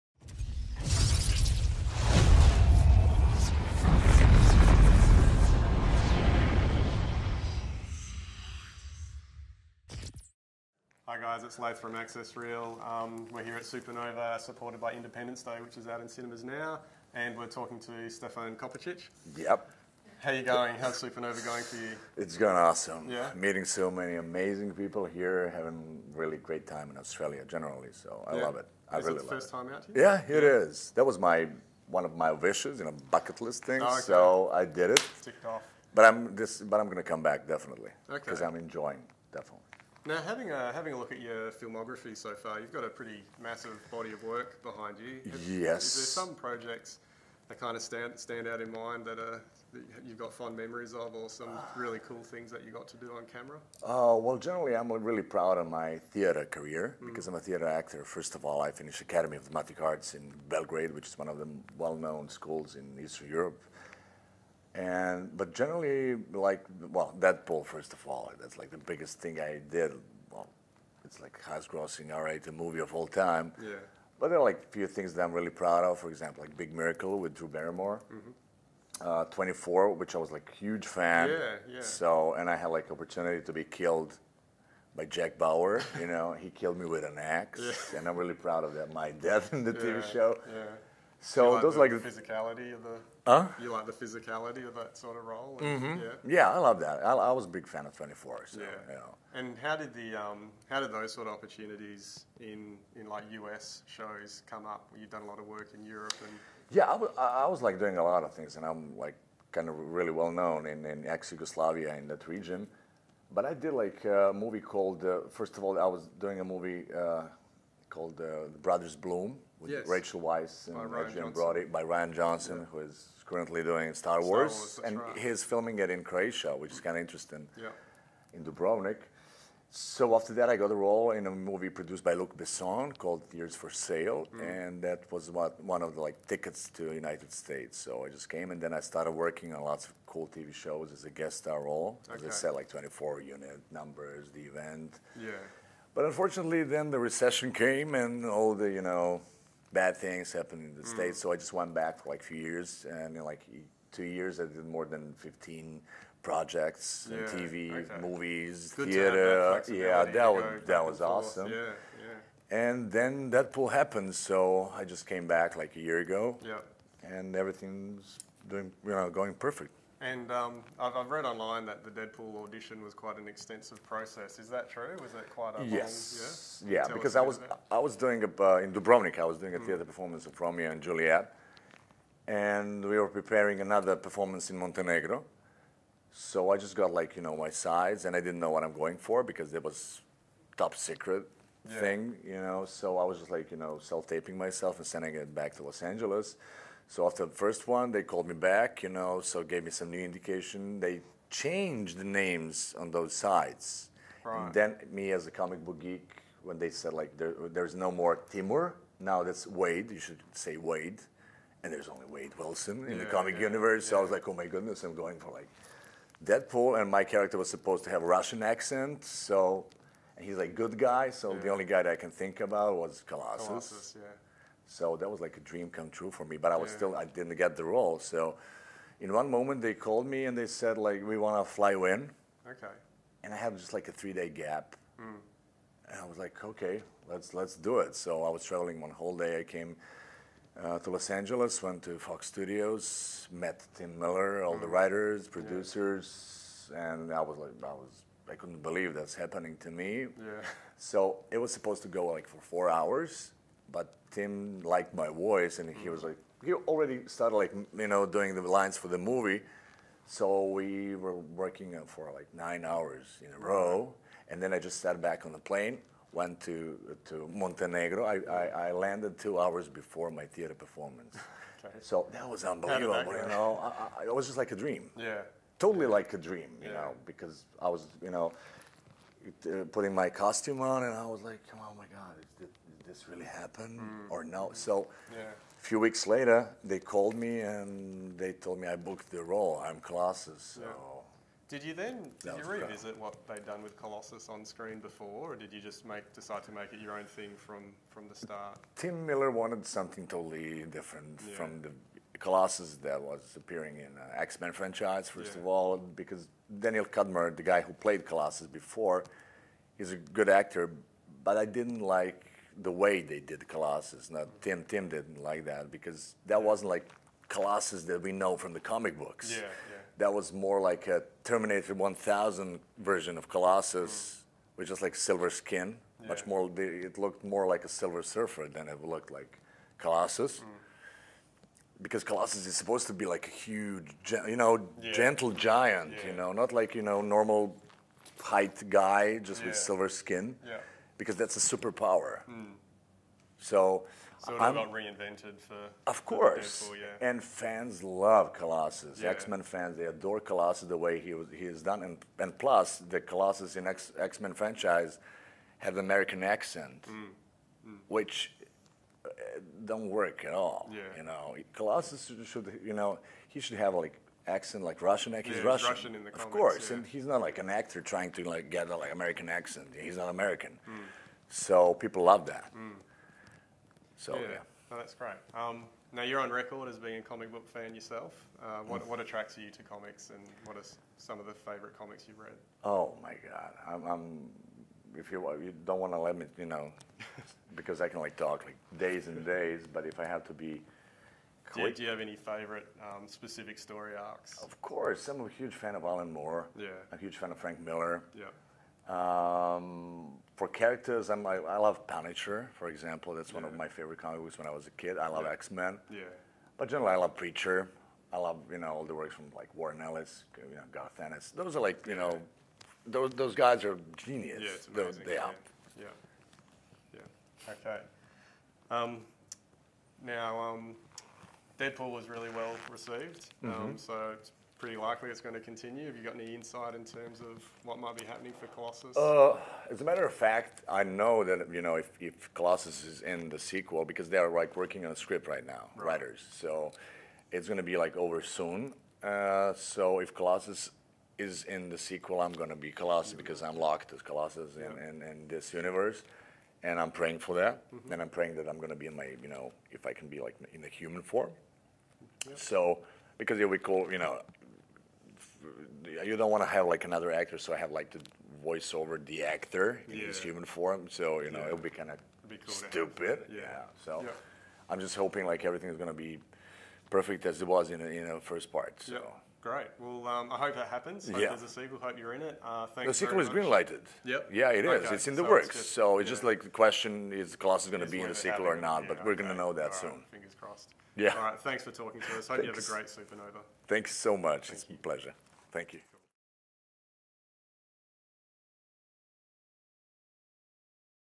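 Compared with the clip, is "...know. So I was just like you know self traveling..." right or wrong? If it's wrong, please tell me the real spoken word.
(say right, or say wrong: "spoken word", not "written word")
wrong: "taping", not "traveling".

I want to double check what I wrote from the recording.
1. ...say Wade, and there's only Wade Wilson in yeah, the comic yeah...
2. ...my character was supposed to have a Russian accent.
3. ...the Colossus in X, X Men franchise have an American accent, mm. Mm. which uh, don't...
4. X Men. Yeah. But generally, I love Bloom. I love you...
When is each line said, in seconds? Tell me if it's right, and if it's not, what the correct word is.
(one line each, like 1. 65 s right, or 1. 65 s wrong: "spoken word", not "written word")
1. 210 s right
2. 216 s right
3. 352 s right
4. 405 s wrong: "Preacher", not "Bloom".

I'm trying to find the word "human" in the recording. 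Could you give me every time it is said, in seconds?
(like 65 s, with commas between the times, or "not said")
450 s, 460 s.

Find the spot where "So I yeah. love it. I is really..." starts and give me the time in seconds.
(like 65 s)
27 s.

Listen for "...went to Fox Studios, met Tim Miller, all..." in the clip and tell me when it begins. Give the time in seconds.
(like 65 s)
241 s.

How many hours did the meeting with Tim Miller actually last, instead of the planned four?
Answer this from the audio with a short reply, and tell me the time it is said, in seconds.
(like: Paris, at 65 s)
9, at 262 s.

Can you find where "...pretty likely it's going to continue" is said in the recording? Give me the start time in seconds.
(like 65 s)
424 s.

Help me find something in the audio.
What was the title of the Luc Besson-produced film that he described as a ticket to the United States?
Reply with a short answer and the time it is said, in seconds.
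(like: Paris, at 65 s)
Years for Sale, at 133 s.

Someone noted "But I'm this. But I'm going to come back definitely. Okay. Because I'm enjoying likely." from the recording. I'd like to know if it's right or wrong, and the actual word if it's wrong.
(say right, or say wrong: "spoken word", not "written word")
wrong: "definitely", not "likely".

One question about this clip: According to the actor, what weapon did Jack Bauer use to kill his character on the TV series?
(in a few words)
An axe.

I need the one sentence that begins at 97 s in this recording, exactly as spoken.
I, I was a big fan of Twenty Four.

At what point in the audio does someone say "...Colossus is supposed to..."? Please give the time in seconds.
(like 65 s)
332 s.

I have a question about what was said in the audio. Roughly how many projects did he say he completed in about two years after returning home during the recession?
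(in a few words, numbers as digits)
More than 15.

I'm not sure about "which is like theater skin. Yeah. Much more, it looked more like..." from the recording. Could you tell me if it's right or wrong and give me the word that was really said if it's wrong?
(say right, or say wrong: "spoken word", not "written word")
wrong: "silver", not "theater".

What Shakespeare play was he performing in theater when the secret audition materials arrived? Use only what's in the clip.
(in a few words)
Romeo and Juliet.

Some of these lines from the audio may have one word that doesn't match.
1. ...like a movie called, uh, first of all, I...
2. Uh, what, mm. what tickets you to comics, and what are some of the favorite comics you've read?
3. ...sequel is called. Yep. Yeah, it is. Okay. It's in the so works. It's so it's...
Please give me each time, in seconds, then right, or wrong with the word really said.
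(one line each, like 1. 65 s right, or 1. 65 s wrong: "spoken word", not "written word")
1. 113 s right
2. 378 s wrong: "attracts", not "tickets"
3. 472 s wrong: "greenlighted", not "called".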